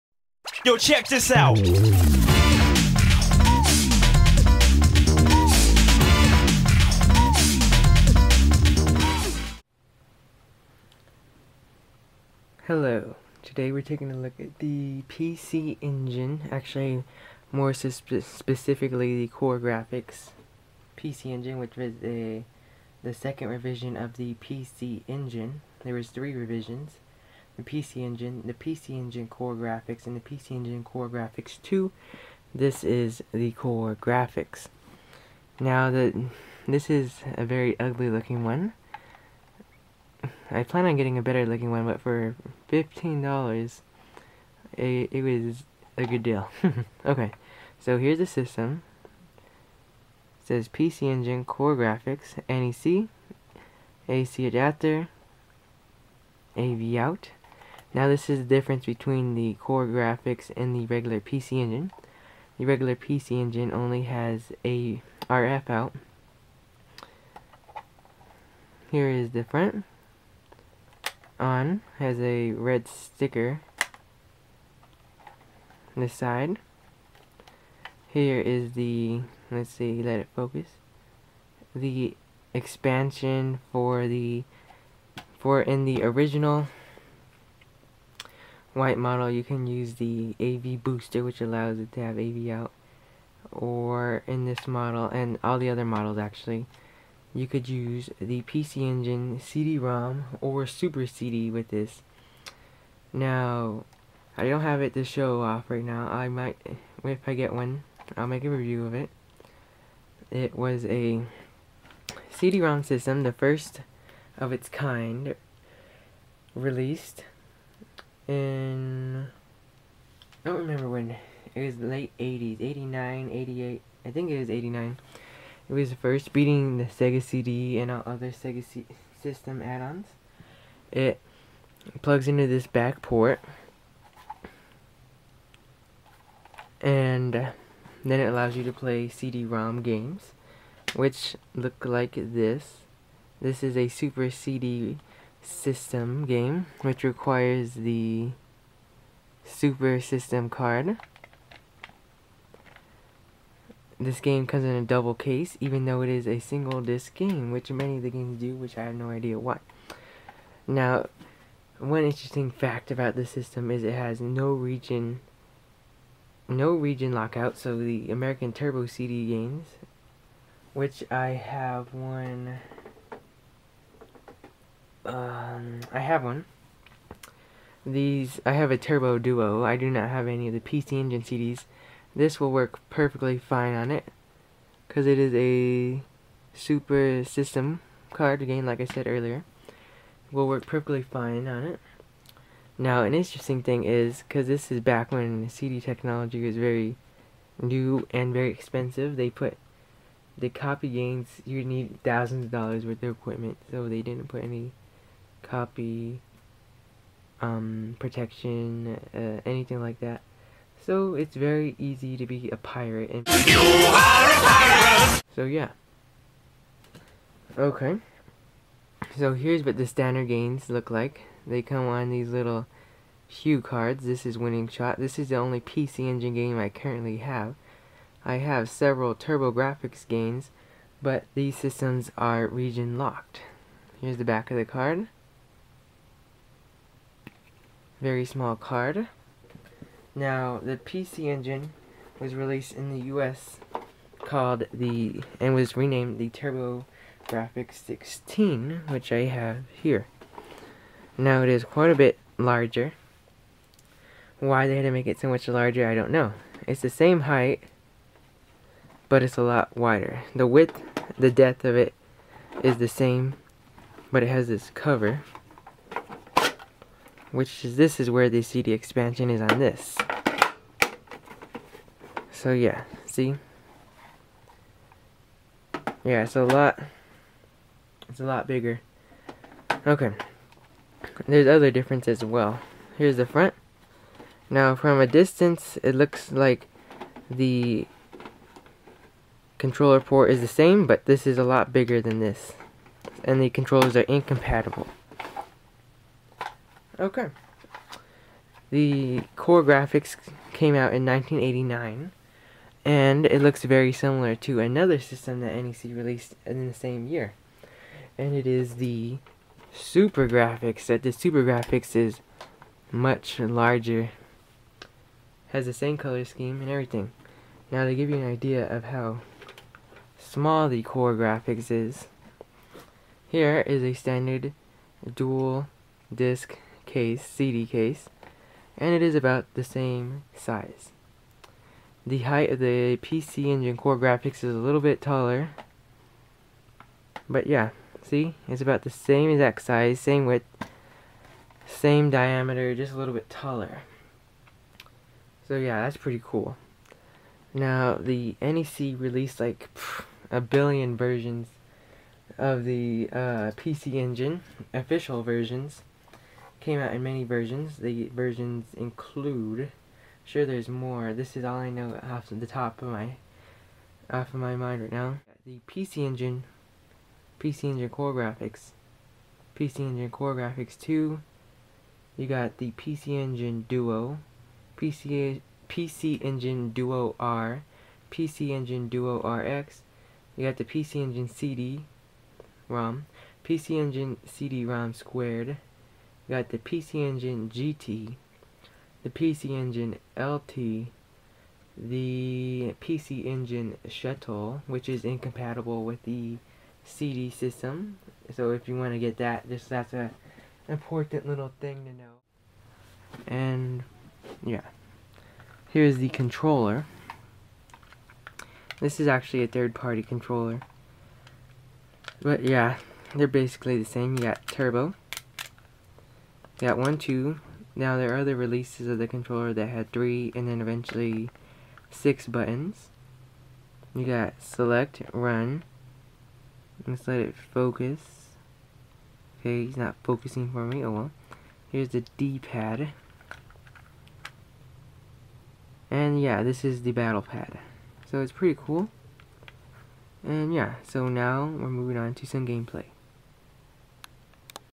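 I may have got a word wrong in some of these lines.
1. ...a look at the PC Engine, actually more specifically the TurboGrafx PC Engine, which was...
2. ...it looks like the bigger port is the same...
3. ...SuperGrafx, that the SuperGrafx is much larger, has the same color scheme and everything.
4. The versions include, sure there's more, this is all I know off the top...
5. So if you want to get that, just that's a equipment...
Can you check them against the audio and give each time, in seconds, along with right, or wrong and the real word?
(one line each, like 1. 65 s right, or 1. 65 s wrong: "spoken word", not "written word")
1. 14 s wrong: "CoreGrafx", not "TurboGrafx"
2. 285 s wrong: "controller", not "bigger"
3. 309 s right
4. 357 s right
5. 398 s wrong: "important", not "equipment".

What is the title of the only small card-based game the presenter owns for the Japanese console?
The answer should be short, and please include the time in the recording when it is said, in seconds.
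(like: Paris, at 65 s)
Winning Shot, at 224 s.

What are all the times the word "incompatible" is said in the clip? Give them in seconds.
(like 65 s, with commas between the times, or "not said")
294 s, 395 s.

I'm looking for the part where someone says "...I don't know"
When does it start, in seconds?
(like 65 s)
255 s.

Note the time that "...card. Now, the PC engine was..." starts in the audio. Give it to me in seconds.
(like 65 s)
238 s.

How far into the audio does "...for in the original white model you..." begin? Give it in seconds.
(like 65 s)
85 s.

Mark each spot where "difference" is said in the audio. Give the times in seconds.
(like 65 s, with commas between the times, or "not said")
58 s, 281 s.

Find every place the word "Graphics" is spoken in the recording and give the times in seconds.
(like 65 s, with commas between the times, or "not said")
247 s.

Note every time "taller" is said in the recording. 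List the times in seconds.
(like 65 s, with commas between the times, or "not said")
335 s, 343 s.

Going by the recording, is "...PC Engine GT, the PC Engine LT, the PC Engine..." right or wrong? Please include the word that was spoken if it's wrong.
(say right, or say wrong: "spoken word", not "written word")
right.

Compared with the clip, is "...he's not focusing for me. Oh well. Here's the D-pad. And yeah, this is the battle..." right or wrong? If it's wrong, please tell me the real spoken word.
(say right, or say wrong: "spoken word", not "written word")
right.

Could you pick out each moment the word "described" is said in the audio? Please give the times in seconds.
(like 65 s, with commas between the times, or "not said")
not said.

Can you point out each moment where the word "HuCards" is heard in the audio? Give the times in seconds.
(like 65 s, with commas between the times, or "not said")
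223 s.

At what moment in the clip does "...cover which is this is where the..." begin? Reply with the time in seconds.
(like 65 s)
264 s.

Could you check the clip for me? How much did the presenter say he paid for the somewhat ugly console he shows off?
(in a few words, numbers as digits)
$15.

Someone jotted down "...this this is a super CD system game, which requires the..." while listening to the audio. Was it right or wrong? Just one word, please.
right.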